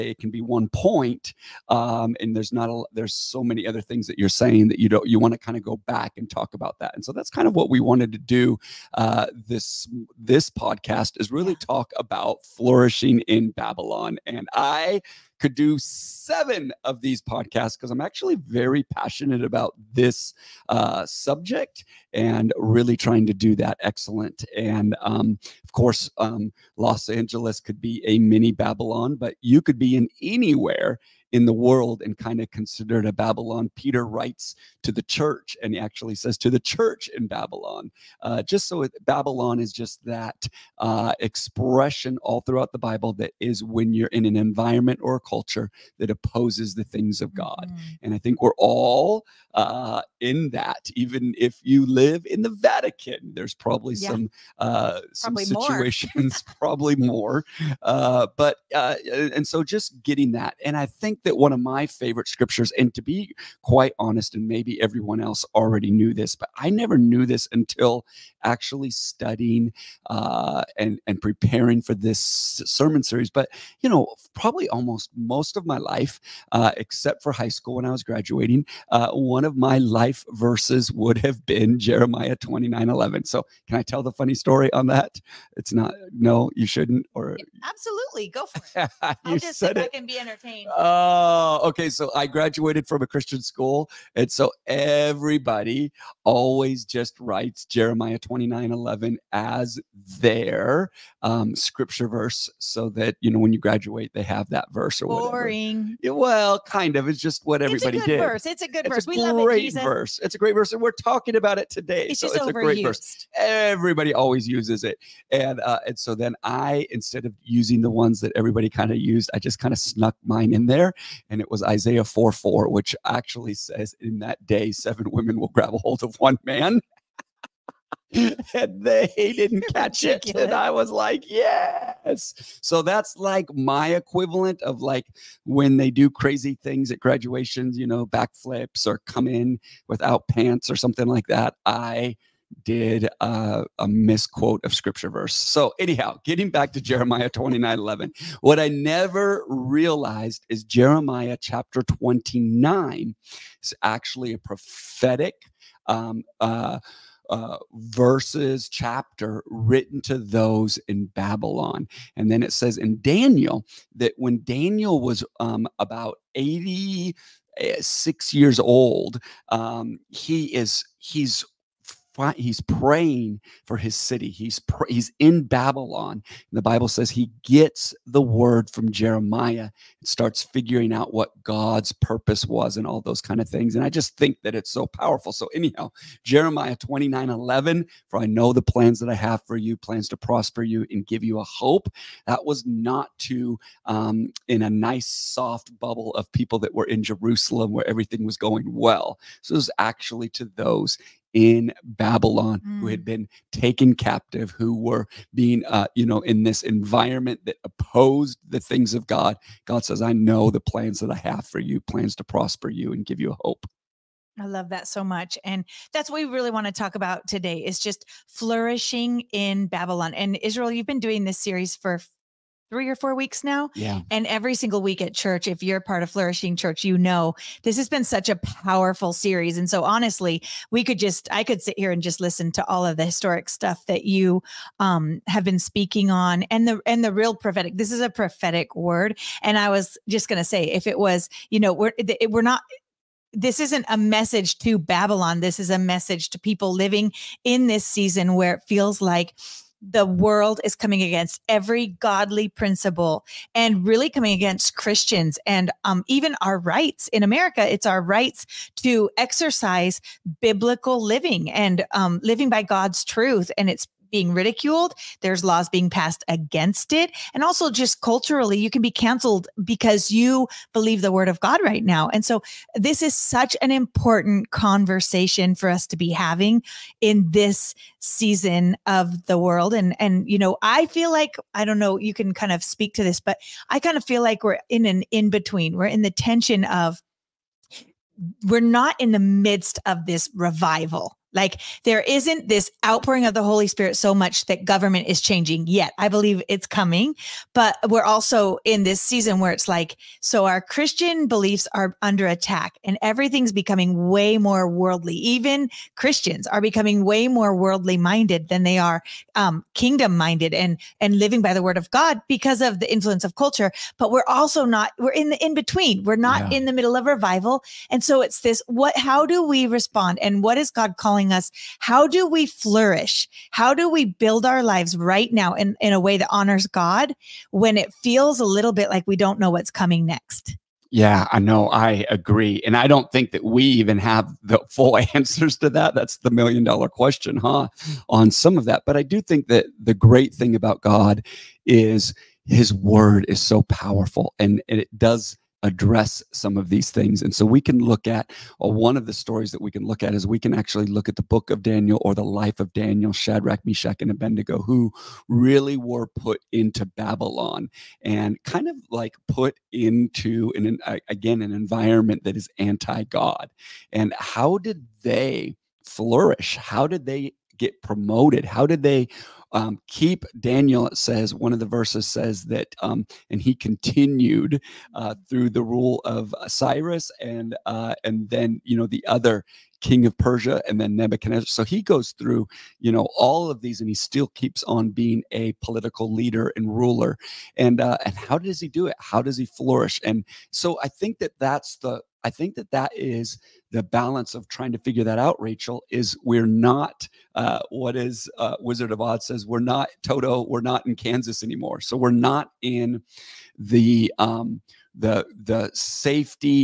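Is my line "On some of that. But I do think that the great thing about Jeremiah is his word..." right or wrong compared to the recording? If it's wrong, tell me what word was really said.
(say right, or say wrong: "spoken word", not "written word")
wrong: "God", not "Jeremiah".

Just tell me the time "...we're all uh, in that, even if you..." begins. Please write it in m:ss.
0:48.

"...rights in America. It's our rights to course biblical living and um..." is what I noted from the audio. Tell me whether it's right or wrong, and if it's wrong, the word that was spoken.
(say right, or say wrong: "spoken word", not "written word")
wrong: "exercise", not "course".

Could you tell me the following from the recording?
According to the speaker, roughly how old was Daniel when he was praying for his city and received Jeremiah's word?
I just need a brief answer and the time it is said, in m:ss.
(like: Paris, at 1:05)
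86, at 2:46.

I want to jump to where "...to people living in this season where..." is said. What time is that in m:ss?
4:06.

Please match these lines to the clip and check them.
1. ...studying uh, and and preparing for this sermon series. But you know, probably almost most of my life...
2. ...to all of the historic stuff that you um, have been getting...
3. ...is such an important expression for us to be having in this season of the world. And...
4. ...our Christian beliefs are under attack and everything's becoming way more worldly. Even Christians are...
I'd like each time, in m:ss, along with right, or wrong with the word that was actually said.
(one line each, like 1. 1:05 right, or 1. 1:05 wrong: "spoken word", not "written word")
1. 1:08 right
2. 3:52 wrong: "speaking", not "getting"
3. 4:33 wrong: "conversation", not "expression"
4. 5:00 right.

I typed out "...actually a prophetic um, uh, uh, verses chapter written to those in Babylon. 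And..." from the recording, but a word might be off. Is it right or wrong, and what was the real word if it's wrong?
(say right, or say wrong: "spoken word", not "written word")
right.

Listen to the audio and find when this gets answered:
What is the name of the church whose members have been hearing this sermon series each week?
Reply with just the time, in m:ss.
3:46.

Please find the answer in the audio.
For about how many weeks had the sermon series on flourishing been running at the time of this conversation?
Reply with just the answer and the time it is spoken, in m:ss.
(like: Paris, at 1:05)
3 or 4 weeks, at 3:42.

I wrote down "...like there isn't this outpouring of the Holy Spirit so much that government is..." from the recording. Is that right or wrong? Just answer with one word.
right.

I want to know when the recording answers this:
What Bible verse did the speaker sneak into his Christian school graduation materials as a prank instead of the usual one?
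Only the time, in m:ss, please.
2:01.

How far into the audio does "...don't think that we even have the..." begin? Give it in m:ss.
5:32.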